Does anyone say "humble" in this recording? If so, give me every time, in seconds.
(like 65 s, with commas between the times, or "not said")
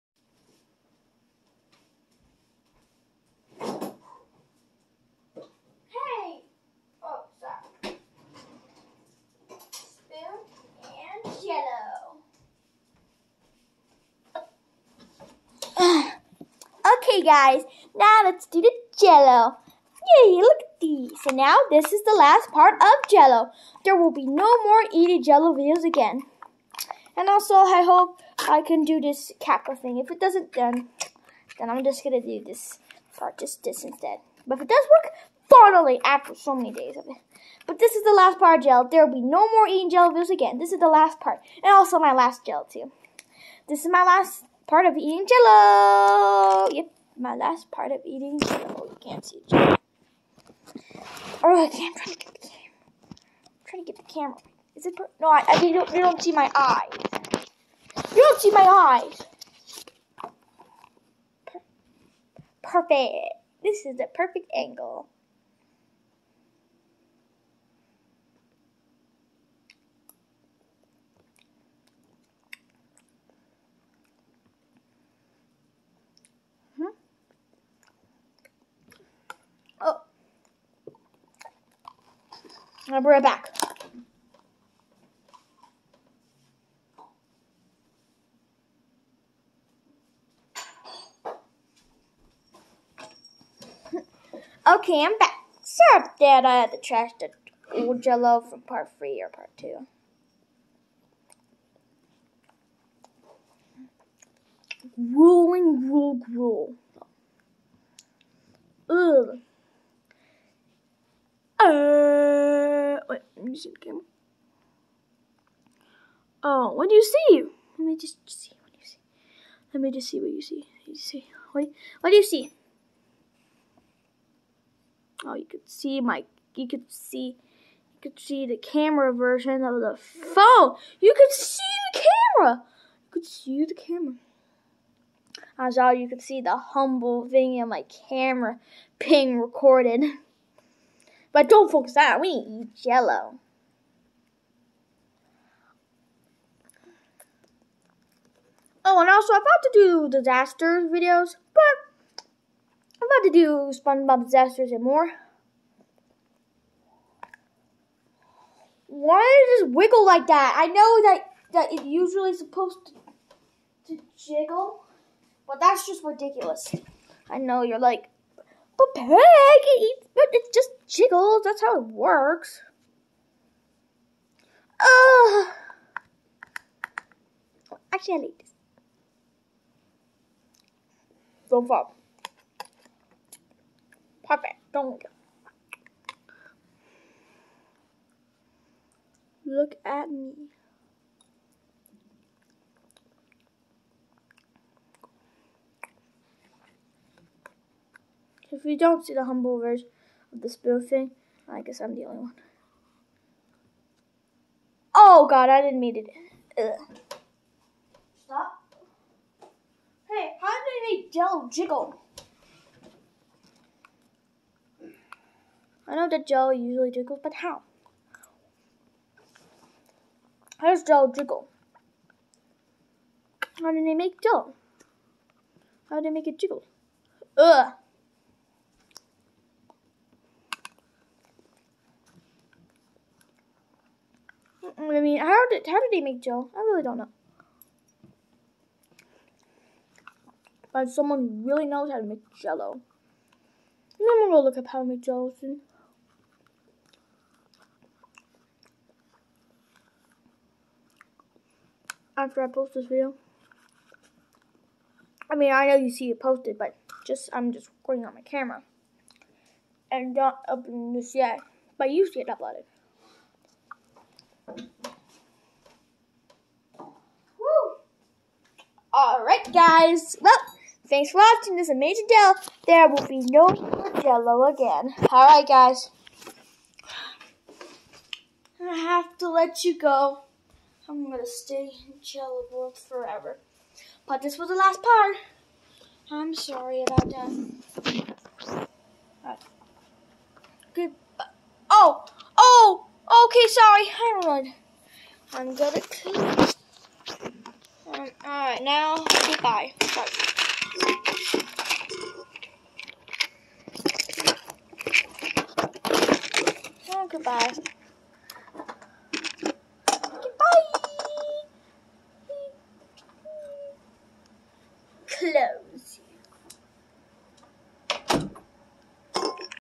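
136 s, 199 s.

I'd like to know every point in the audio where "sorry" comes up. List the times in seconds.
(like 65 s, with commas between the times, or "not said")
95 s, 286 s, 293 s, 299 s.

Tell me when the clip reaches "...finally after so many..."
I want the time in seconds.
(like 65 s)
35 s.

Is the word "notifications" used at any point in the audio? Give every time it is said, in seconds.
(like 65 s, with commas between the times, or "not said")
not said.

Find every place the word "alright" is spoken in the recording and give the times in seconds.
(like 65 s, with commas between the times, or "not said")
269 s, 275 s, 298 s.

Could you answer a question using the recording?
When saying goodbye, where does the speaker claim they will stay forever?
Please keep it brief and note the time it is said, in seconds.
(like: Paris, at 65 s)
Jello World, at 282 s.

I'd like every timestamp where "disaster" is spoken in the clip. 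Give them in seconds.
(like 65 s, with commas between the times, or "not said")
150 s, 154 s.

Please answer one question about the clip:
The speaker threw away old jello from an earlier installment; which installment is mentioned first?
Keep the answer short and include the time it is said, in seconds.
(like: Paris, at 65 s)
part three, at 98 s.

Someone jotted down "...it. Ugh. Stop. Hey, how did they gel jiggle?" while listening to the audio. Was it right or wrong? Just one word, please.
right.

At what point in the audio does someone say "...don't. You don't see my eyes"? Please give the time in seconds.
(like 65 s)
55 s.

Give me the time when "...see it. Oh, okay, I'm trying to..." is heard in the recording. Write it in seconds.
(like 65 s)
49 s.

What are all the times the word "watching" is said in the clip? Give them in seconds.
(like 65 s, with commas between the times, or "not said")
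271 s.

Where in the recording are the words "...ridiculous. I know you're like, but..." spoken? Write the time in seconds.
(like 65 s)
166 s.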